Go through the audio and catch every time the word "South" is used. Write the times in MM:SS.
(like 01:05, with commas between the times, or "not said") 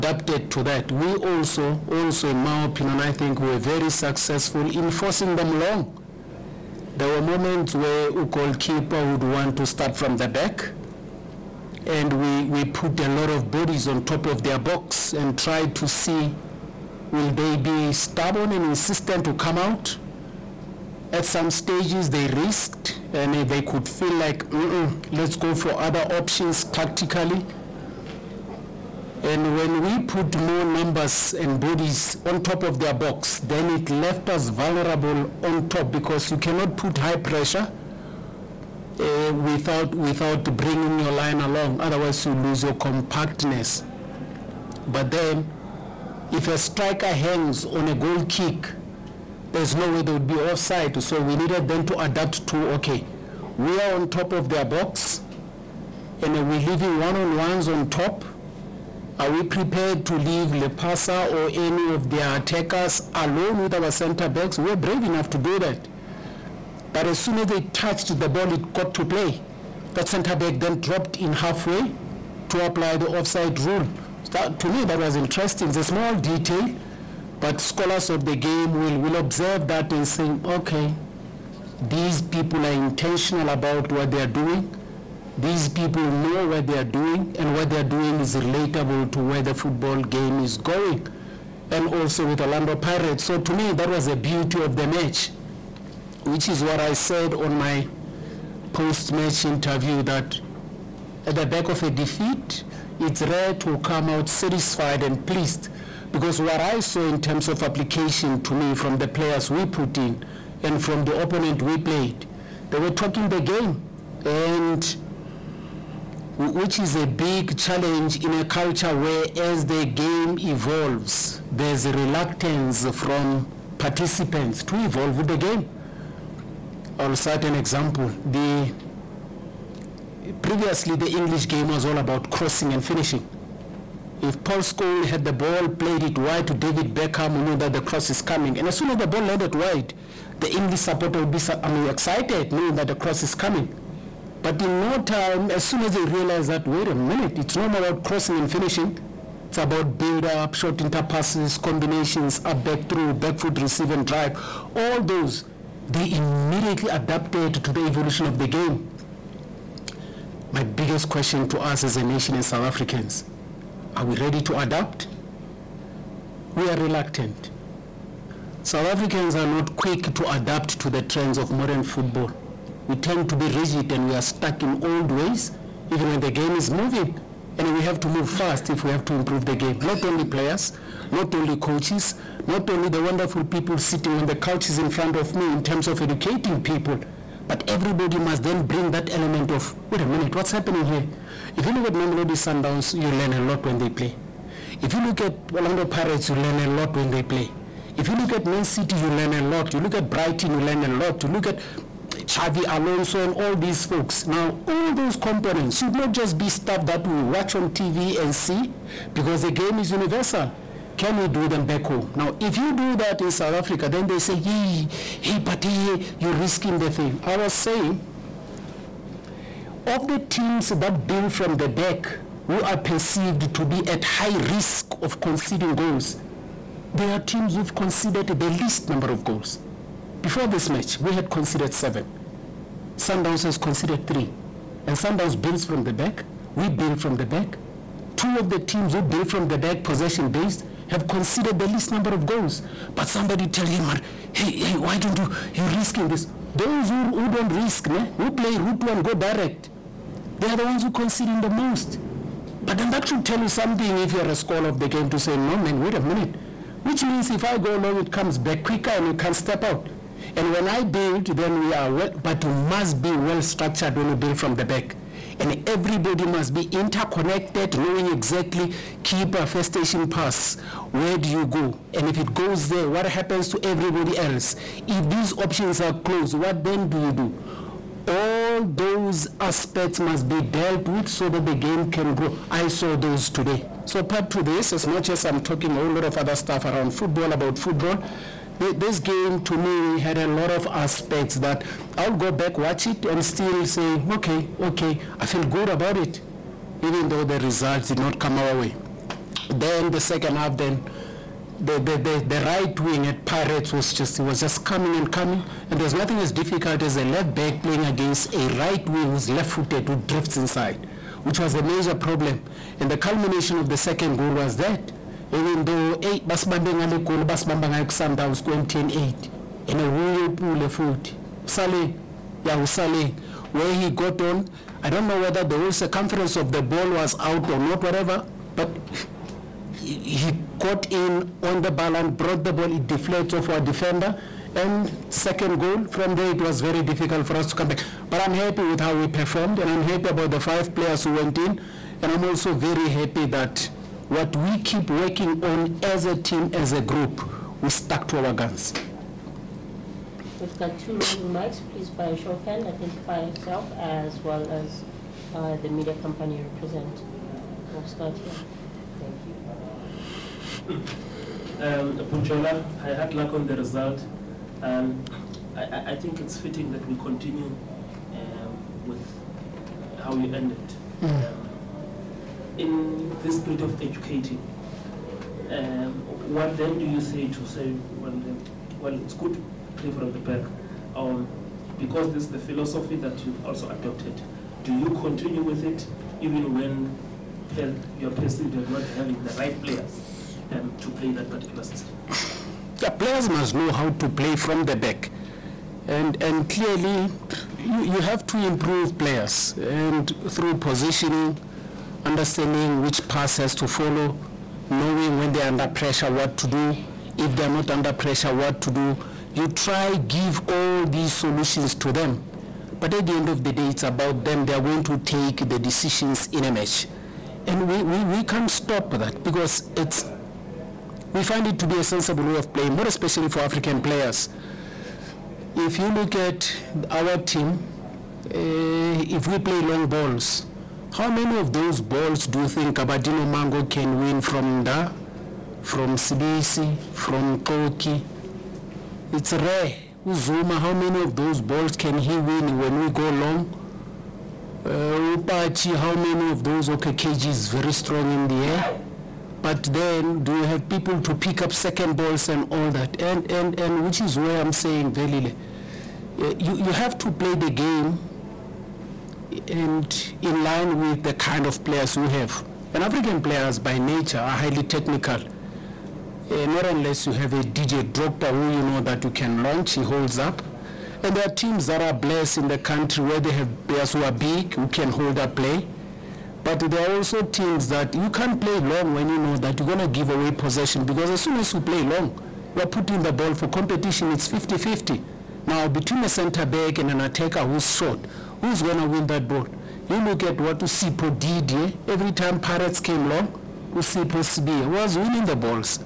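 02:42, 02:48, 03:33.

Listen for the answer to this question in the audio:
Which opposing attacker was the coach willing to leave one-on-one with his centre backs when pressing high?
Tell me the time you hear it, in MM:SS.
01:00.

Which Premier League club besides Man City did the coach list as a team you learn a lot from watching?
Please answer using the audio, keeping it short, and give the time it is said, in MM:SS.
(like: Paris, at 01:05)
Brighton, at 03:20.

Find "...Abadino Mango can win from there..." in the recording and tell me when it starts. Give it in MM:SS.
07:12.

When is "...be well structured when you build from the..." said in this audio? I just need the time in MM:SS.
04:23.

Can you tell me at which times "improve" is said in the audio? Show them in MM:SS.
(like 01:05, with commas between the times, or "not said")
02:59, 06:38.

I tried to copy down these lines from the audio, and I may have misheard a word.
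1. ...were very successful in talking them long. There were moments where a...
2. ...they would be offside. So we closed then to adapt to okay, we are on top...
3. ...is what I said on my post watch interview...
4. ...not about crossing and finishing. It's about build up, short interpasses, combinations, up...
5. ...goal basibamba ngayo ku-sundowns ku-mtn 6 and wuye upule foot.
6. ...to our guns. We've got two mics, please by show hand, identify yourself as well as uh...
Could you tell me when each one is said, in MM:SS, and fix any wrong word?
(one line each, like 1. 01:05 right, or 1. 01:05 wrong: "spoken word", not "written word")
1. 00:03 wrong: "forcing", not "talking"
2. 00:50 wrong: "needed", not "closed"
3. 01:36 wrong: "match", not "watch"
4. 02:27 right
5. 05:17 wrong: "8", not "6"
6. 05:48 right.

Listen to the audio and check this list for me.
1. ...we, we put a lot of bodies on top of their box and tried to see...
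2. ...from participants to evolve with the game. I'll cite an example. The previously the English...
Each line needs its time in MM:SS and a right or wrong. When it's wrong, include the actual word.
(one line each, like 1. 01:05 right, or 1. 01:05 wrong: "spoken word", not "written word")
1. 00:12 right
2. 02:02 right.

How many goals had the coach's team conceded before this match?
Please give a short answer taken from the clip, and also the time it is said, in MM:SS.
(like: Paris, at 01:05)
7, at 03:51.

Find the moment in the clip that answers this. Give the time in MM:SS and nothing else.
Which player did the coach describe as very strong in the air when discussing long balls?
07:26.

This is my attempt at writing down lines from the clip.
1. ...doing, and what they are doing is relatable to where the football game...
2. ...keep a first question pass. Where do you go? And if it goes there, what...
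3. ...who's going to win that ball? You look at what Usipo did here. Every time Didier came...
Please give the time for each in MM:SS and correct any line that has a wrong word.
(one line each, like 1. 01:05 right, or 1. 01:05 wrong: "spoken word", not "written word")
1. 01:26 right
2. 04:29 wrong: "station", not "question"
3. 08:08 wrong: "Pirates", not "Didier".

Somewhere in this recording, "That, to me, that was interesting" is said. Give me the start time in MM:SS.
01:14.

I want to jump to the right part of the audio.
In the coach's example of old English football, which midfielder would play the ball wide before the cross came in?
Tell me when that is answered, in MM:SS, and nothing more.
02:14.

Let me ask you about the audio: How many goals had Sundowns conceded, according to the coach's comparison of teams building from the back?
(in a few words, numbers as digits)
3.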